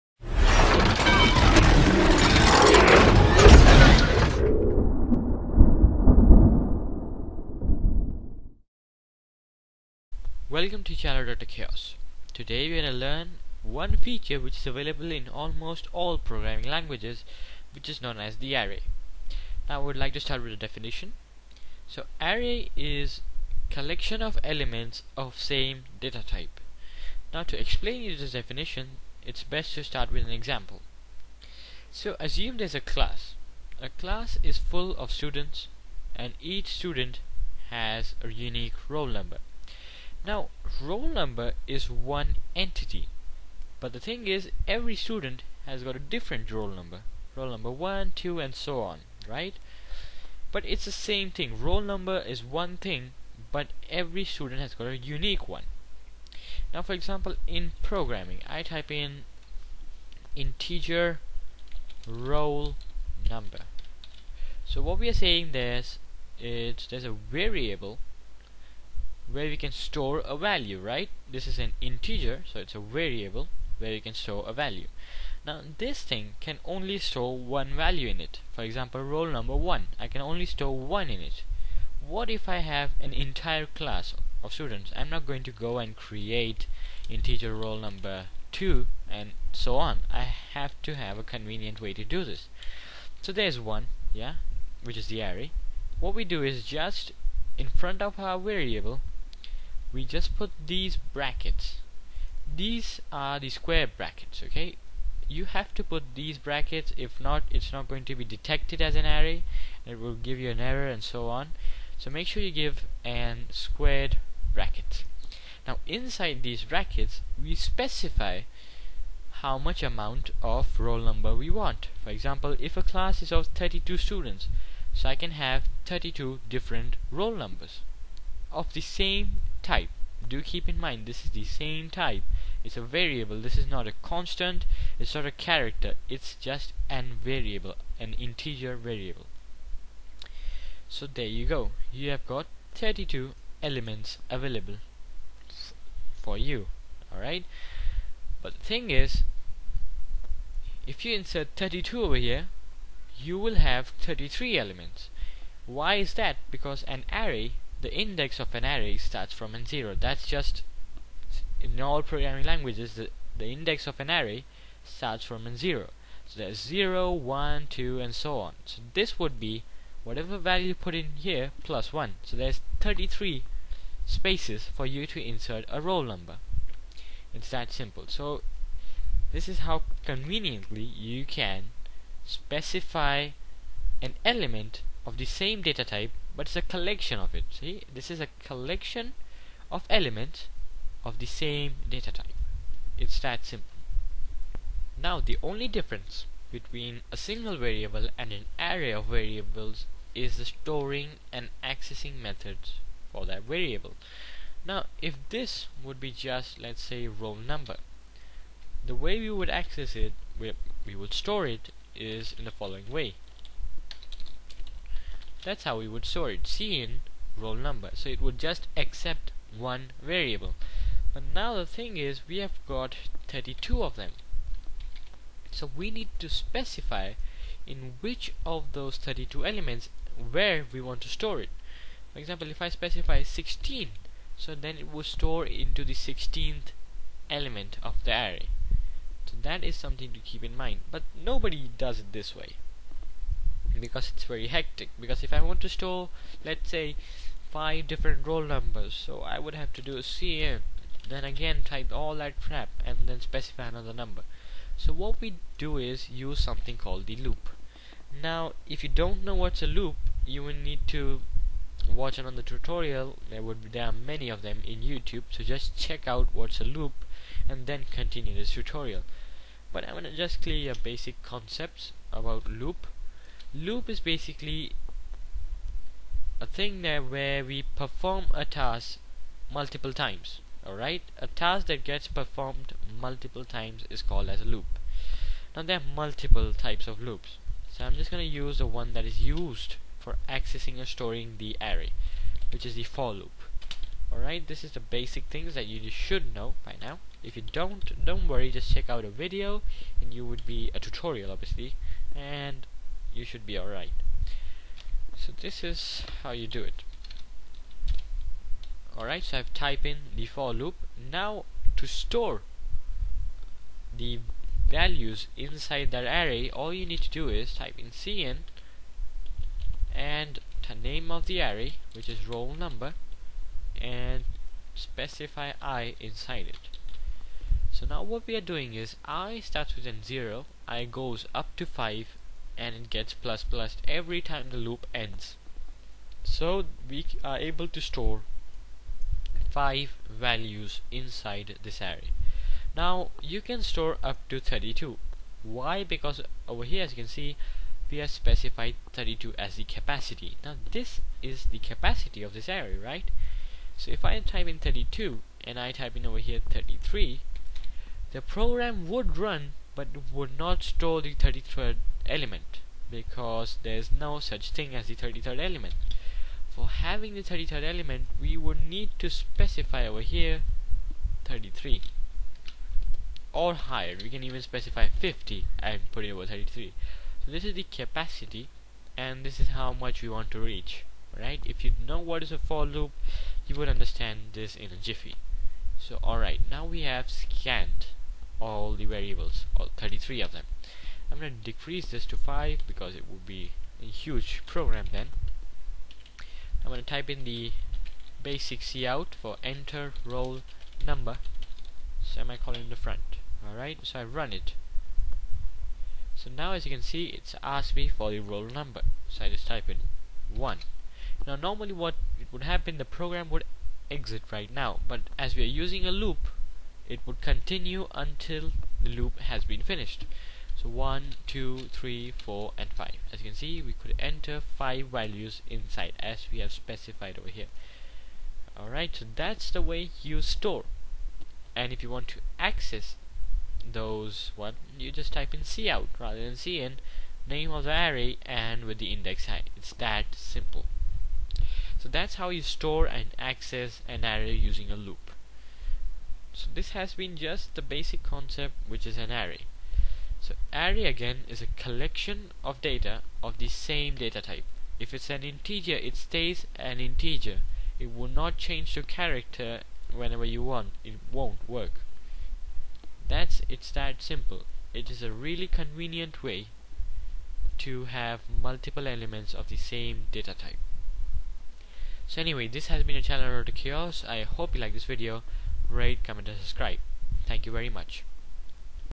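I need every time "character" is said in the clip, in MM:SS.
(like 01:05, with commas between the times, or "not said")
02:15, 07:38.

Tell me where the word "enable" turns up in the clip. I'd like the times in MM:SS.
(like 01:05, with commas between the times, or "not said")
not said.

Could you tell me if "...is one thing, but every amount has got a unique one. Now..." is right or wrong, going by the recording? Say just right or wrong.
wrong.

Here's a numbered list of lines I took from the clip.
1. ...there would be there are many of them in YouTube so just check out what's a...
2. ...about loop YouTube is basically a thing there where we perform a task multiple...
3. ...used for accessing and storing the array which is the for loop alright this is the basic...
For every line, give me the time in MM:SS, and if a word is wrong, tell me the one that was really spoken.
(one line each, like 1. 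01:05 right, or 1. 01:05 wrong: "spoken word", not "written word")
1. 04:23 right
2. 04:32 wrong: "Loop", not "YouTube"
3. 04:49 right.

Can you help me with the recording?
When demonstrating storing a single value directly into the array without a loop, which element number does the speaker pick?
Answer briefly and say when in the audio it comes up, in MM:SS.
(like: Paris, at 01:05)
16, at 03:53.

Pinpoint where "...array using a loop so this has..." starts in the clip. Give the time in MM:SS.
07:24.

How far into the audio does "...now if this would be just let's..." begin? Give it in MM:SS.
03:24.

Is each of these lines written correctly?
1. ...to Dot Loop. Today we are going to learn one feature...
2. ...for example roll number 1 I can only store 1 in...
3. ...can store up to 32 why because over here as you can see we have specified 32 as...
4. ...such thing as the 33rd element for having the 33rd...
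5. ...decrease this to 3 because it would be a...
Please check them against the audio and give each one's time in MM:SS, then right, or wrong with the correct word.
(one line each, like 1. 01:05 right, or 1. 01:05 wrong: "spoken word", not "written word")
1. 00:10 wrong: "Caos", not "Loop"
2. 01:18 right
3. 05:43 right
4. 06:04 right
5. 06:31 wrong: "5", not "3".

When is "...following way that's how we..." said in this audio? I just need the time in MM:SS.
03:32.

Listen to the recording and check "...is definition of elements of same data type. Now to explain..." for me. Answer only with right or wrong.
wrong.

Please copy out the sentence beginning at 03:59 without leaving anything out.
So that is something to keep in mind.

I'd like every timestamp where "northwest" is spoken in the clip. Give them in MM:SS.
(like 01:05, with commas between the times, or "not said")
not said.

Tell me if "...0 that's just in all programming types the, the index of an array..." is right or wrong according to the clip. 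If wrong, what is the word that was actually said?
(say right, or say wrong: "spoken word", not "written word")
wrong: "languages", not "types".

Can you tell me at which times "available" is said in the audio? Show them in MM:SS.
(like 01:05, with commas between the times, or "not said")
00:14, 02:24.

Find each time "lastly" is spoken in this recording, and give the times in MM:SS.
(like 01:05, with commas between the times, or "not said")
not said.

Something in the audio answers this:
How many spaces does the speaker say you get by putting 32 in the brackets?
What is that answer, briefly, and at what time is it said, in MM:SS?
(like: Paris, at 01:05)
33, at 02:52.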